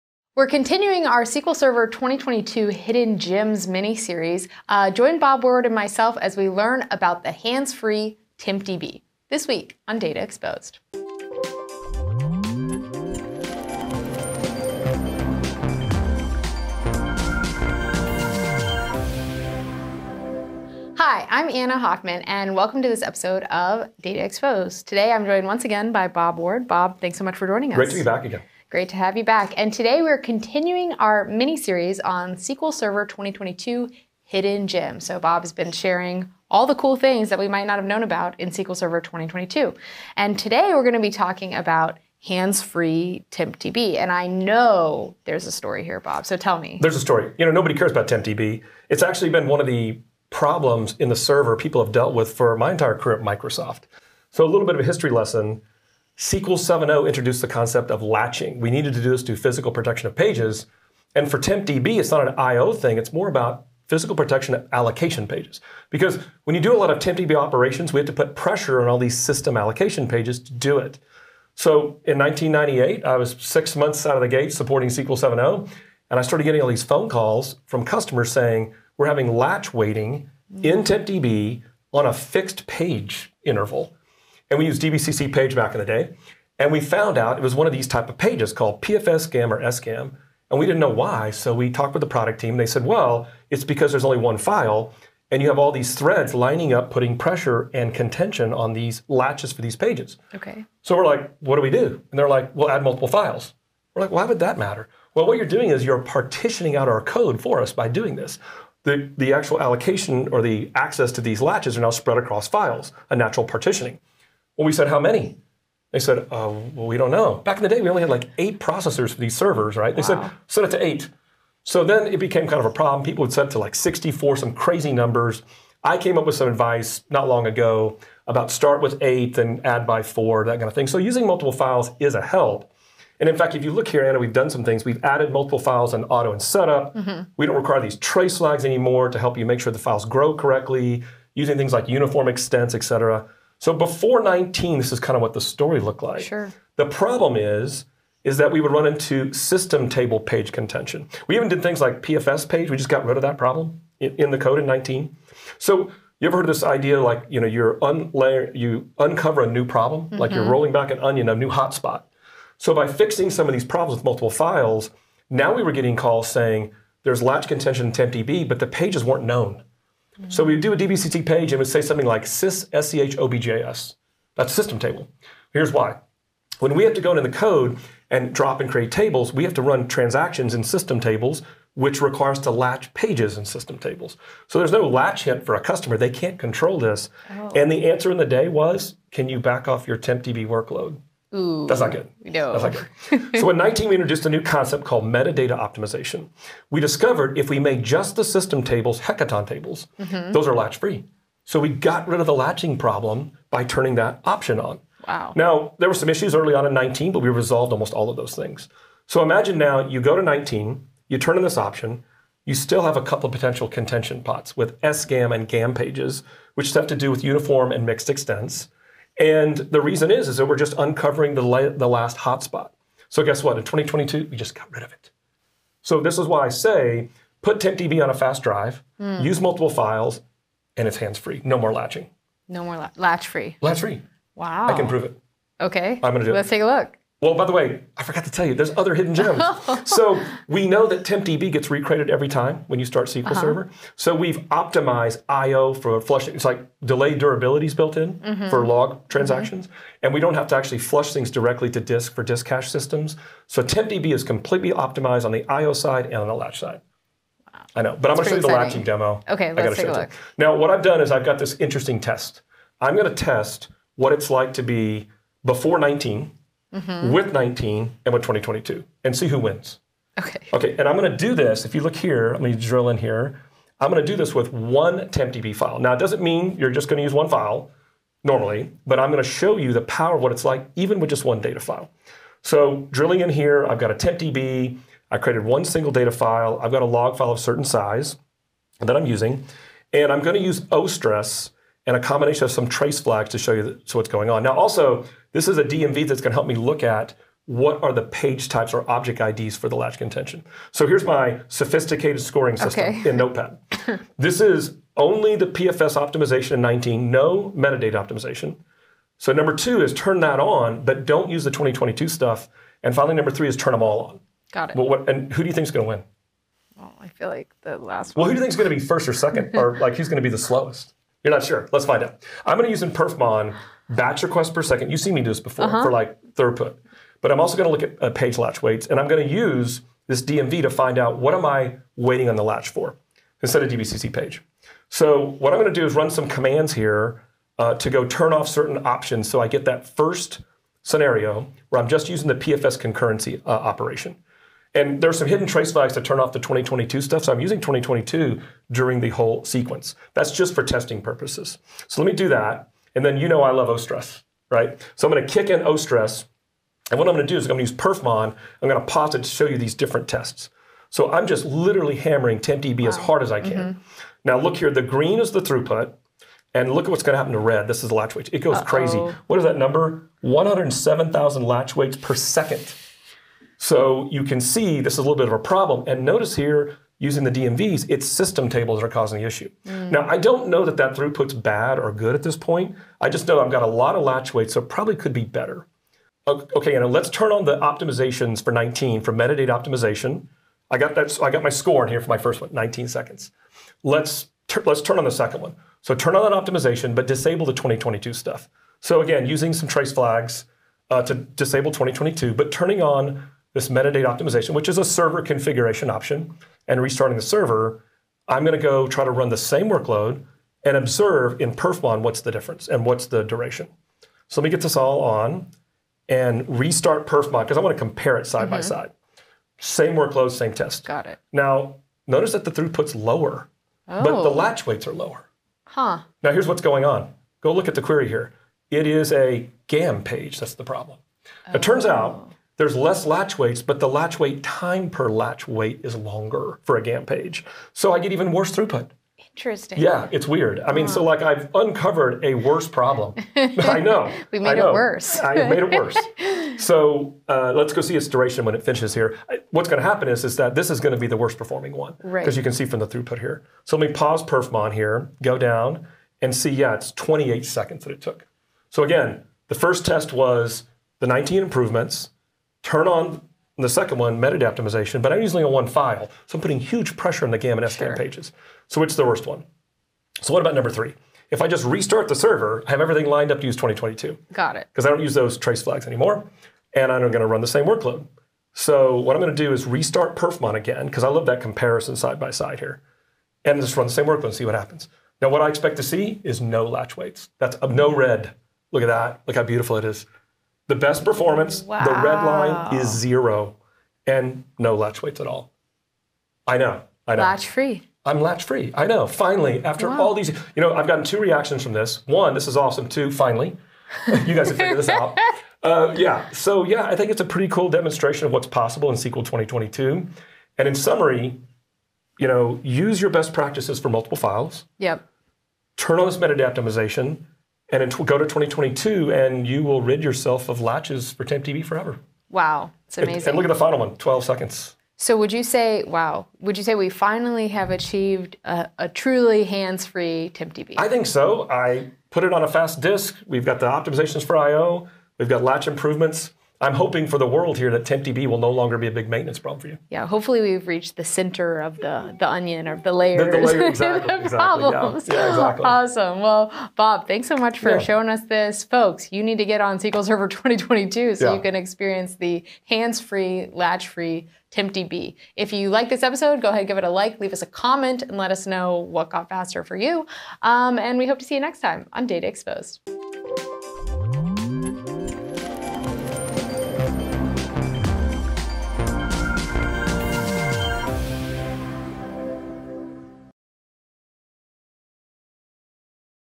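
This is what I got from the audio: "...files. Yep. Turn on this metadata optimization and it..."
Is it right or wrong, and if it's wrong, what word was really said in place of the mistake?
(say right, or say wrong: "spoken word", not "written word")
right.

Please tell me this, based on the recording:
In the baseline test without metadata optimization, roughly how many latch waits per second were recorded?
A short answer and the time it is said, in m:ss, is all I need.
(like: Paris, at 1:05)
107,000, at 6:10.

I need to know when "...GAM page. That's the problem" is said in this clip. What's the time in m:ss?
7:09.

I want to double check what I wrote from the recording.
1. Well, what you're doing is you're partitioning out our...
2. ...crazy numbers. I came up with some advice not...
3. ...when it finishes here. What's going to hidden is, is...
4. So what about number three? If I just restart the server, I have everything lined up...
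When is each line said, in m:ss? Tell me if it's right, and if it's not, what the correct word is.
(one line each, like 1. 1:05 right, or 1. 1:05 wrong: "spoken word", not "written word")
1. 1:45 right
2. 2:04 right
3. 7:28 wrong: "happen", not "hidden"
4. 7:50 right.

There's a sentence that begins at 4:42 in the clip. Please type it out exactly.
So drilling in here, I've got a TempDB.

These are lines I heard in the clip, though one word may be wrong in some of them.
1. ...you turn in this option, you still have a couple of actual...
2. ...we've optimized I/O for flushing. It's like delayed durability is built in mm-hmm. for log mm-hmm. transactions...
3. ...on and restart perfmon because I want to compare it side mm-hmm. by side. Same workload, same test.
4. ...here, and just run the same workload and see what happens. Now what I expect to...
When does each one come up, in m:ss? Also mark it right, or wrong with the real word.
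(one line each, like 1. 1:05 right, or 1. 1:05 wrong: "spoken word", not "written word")
1. 3:31 wrong: "potential", not "actual"
2. 4:04 right
3. 6:55 right
4. 8:02 right.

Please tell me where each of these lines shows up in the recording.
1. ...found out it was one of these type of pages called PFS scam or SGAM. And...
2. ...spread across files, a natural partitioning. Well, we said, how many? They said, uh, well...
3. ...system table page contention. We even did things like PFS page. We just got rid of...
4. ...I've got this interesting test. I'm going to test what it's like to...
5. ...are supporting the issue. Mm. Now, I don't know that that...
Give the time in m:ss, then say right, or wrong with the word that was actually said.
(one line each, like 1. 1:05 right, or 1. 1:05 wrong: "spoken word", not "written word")
1. 1:26 right
2. 1:51 right
3. 2:29 right
4. 4:21 right
5. 6:18 wrong: "causing", not "supporting".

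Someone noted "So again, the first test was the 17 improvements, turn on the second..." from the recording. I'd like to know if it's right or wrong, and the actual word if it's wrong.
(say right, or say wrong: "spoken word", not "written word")
wrong: "19", not "17".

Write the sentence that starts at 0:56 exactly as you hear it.
SQL 7.0 introduced the concept of latching.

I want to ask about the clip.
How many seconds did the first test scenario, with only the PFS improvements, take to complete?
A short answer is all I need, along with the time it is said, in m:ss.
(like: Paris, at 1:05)
19 seconds, at 6:32.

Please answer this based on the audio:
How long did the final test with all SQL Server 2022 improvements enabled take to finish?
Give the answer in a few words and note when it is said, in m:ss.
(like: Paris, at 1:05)
12 seconds, at 8:43.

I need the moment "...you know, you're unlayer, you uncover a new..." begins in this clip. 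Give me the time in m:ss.
2:37.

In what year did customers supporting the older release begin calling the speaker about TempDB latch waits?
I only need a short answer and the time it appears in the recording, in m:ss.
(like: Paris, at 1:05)
1998, at 1:12.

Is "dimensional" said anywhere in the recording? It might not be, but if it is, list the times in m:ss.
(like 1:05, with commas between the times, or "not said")
not said.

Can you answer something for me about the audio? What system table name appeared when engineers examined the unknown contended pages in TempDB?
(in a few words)
sys schobjs.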